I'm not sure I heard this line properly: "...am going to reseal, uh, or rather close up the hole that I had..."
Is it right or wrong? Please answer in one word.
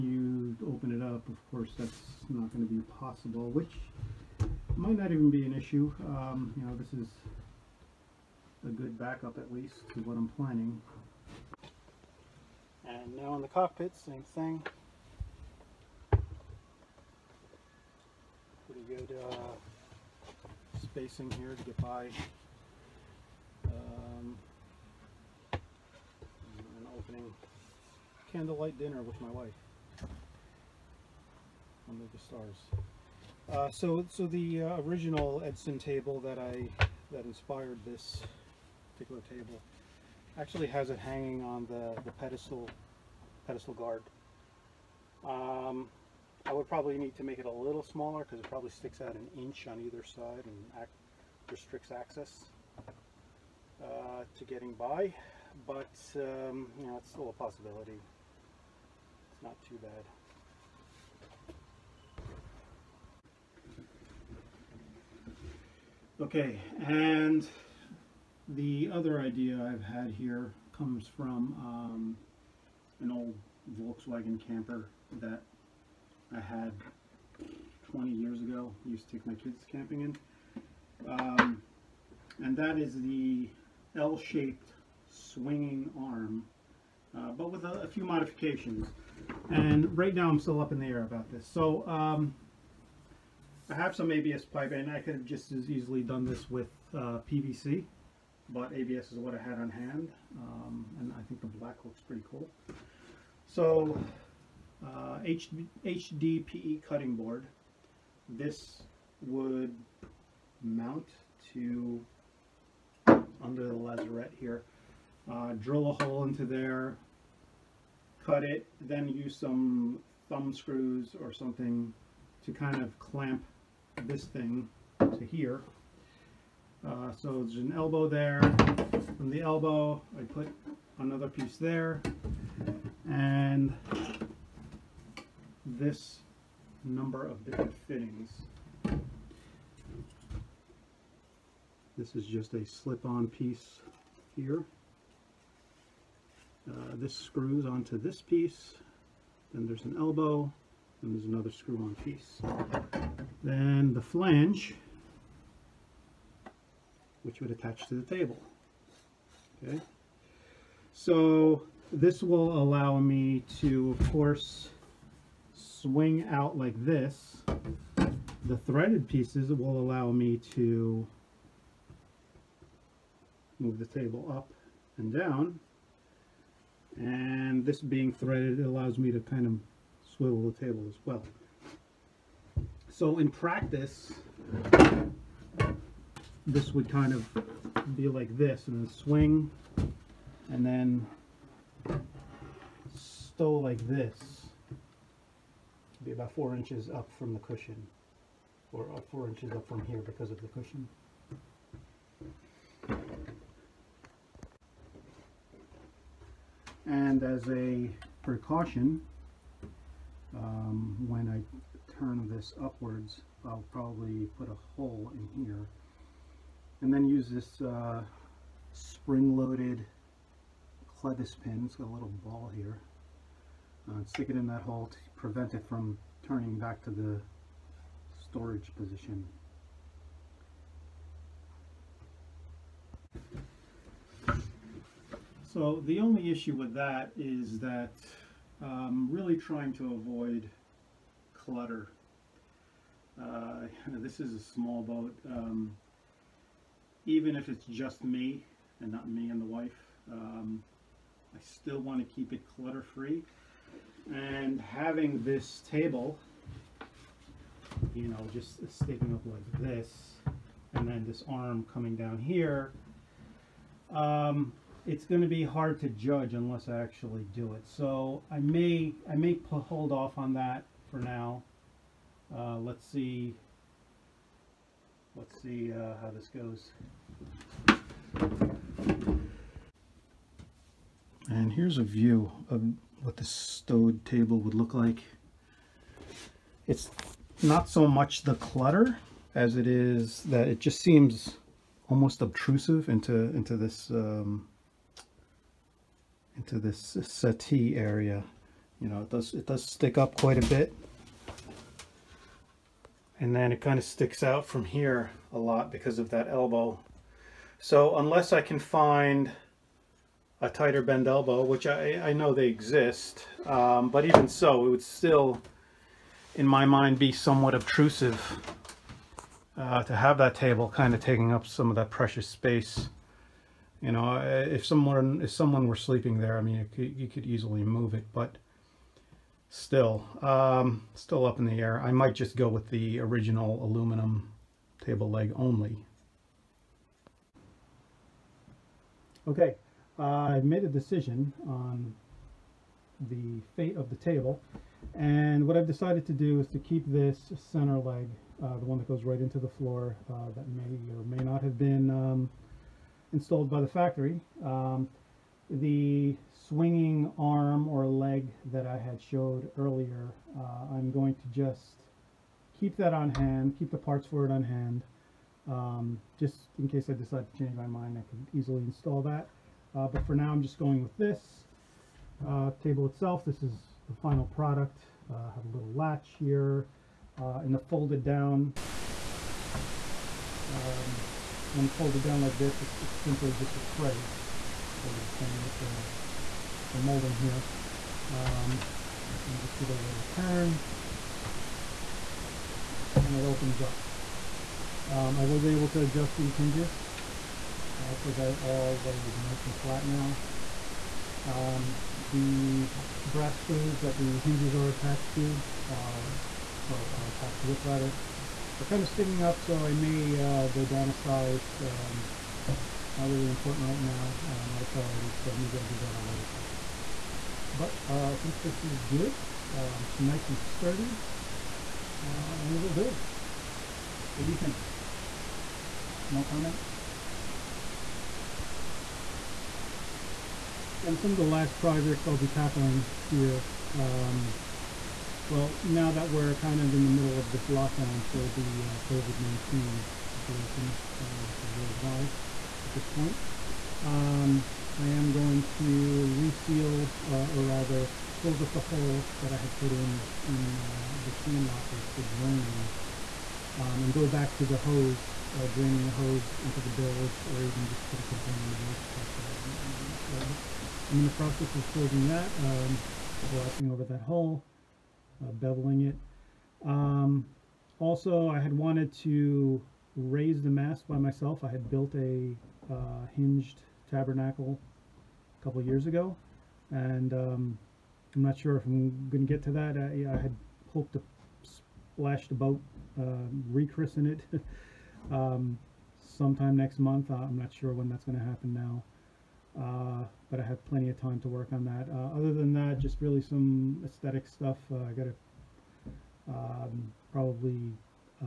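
right.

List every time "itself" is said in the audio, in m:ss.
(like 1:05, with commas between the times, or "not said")
6:12.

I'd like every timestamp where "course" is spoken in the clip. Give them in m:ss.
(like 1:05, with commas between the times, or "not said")
0:01, 2:44.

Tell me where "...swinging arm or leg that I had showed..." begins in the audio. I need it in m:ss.
5:56.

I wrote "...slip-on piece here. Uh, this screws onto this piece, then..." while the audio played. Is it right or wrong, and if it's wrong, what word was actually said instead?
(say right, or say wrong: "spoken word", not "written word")
right.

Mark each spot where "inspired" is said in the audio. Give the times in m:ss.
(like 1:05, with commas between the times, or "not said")
0:37.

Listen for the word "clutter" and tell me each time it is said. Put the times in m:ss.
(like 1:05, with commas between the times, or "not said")
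4:01, 4:12, 4:48.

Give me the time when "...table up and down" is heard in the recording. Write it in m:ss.
2:53.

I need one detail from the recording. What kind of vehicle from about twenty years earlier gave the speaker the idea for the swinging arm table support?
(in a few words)
Volkswagen camper.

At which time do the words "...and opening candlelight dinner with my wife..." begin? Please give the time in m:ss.
0:25.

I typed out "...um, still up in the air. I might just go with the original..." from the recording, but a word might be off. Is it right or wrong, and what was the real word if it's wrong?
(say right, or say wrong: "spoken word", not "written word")
right.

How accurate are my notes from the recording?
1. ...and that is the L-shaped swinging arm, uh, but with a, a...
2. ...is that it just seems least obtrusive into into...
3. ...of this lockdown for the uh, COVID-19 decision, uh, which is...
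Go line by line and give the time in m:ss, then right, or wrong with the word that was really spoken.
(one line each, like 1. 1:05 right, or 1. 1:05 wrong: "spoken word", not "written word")
1. 1:22 right
2. 4:49 wrong: "almost", not "least"
3. 7:17 wrong: "situation", not "decision".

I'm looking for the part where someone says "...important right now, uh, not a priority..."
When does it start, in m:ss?
6:53.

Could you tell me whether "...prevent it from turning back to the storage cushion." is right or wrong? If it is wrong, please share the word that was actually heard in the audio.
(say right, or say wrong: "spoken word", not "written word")
wrong: "position", not "cushion".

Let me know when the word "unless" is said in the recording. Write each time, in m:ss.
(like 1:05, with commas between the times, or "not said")
4:26, 5:07.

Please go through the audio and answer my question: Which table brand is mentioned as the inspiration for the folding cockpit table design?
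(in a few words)
Edson.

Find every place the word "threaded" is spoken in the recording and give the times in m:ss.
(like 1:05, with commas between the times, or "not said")
2:48, 2:58.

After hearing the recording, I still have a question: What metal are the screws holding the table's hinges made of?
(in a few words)
brass.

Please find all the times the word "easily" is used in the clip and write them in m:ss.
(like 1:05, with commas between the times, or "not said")
1:35, 5:27, 6:08.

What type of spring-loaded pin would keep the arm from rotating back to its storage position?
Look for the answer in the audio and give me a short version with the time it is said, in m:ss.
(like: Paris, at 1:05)
clevis pin, at 3:40.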